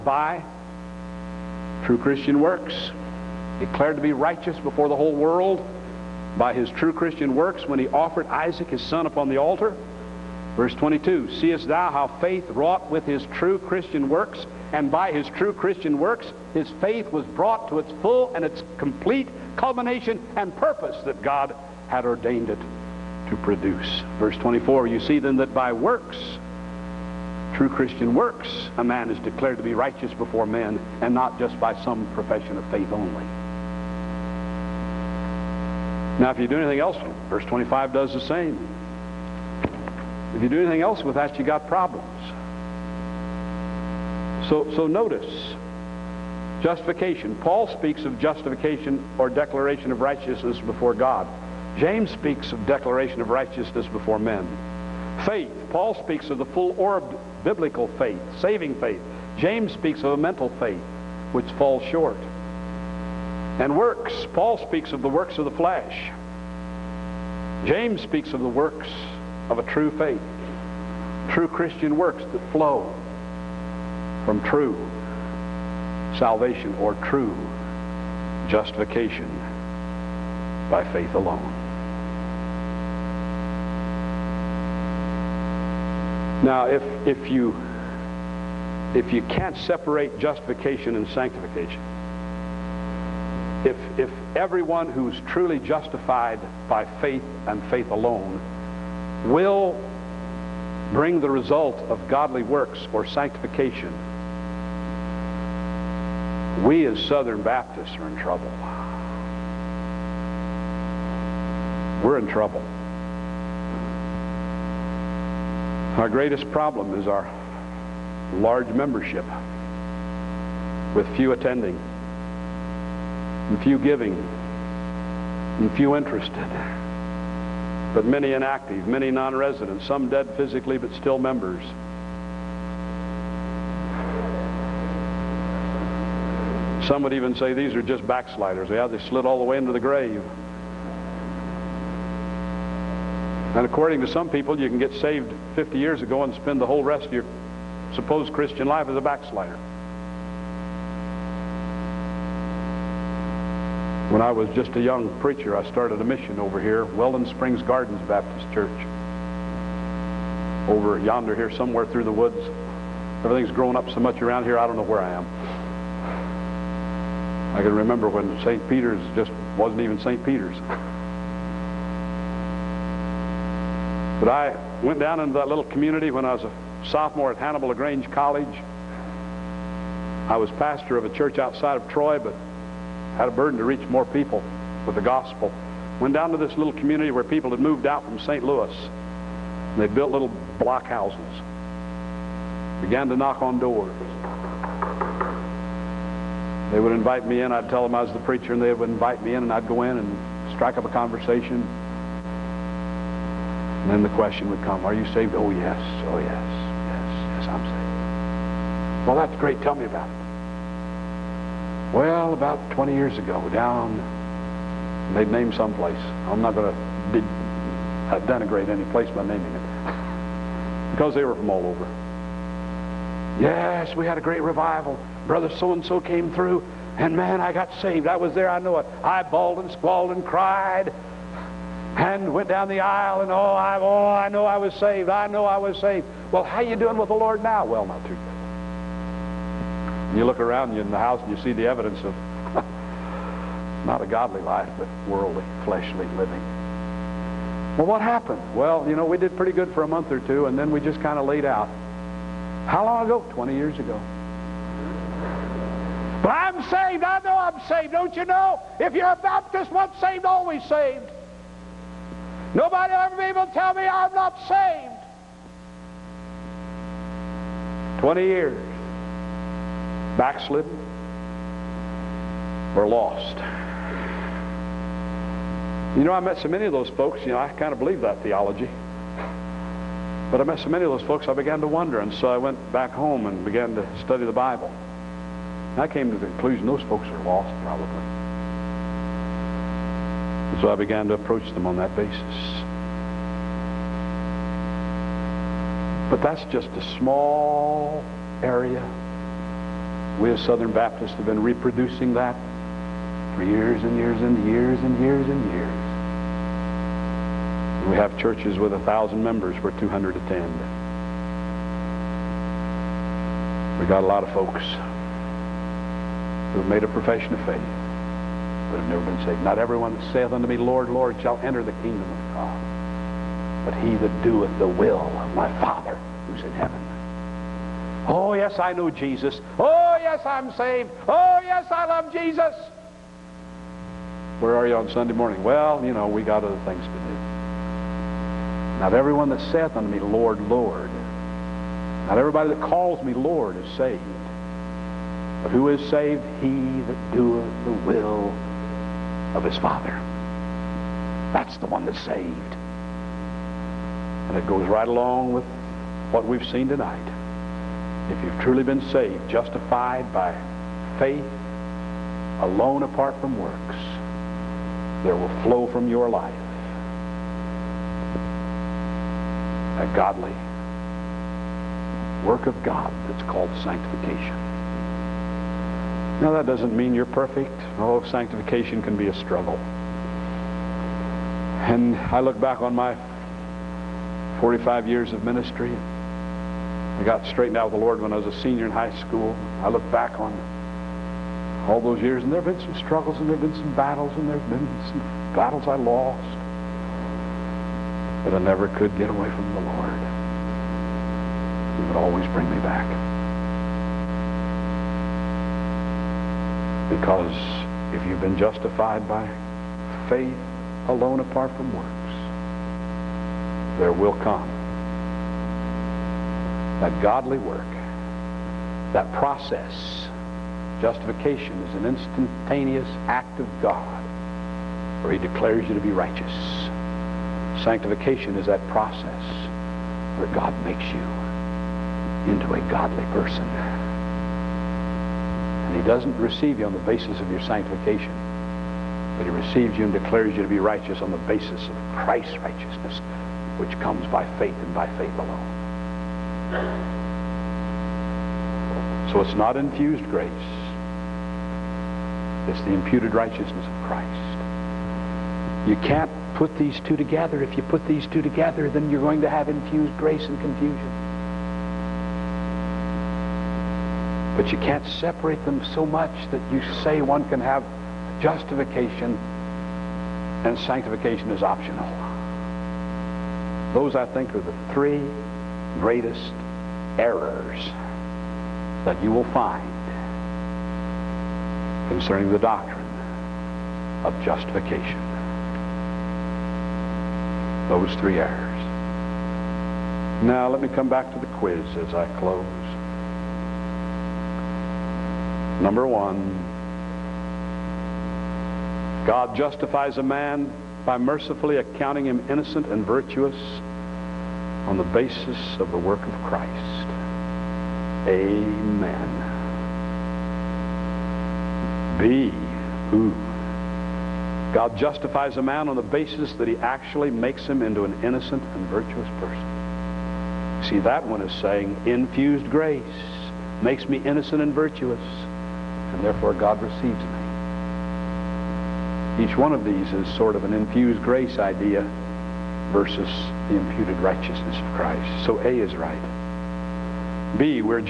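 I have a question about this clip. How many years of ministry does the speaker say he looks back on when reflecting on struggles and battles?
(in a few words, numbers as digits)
45.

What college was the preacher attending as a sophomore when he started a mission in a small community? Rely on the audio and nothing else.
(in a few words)
Hannibal LaGrange College.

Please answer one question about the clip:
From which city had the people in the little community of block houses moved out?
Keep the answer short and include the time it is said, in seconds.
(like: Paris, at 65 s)
St. Louis, at 188 s.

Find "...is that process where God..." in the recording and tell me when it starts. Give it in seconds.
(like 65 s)
428 s.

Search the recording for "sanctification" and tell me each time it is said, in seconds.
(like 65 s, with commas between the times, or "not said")
91 s, 103 s, 373 s, 378 s, 427 s, 437 s, 470 s.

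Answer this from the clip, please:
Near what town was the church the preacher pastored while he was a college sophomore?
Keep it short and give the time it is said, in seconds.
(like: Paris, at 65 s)
Troy, at 181 s.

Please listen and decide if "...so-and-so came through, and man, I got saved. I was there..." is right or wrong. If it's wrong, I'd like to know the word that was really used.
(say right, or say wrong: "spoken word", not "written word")
right.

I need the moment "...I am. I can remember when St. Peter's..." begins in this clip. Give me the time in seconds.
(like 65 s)
165 s.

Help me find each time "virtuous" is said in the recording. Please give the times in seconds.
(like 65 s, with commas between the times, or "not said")
502 s, 518 s, 524 s.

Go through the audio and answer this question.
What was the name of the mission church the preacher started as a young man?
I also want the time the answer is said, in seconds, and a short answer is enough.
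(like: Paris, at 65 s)
Welland Springs Gardens Baptist Church, at 156 s.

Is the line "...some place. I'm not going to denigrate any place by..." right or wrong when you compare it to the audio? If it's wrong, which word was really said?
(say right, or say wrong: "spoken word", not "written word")
right.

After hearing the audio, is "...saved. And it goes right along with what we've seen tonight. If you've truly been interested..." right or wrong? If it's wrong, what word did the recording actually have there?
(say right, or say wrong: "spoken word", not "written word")
wrong: "saved", not "interested".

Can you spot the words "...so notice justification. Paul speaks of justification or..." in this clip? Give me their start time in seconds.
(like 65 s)
44 s.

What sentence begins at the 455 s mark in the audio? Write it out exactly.
You can't put these two together.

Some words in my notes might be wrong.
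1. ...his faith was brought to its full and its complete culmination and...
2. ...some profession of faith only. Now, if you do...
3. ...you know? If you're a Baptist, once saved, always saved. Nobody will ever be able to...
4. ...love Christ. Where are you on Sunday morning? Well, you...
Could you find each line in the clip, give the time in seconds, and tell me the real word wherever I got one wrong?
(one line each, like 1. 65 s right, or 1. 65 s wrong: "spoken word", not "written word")
1. 16 s right
2. 31 s right
3. 258 s right
4. 331 s wrong: "Jesus", not "Christ".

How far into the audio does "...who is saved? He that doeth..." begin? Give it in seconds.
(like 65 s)
345 s.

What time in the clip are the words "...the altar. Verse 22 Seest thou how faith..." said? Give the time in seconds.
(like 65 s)
9 s.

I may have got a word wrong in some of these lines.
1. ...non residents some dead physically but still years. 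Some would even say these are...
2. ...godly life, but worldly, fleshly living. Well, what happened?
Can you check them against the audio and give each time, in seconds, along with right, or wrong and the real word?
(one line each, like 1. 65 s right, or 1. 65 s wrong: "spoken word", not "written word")
1. 129 s wrong: "members", not "years"
2. 244 s right.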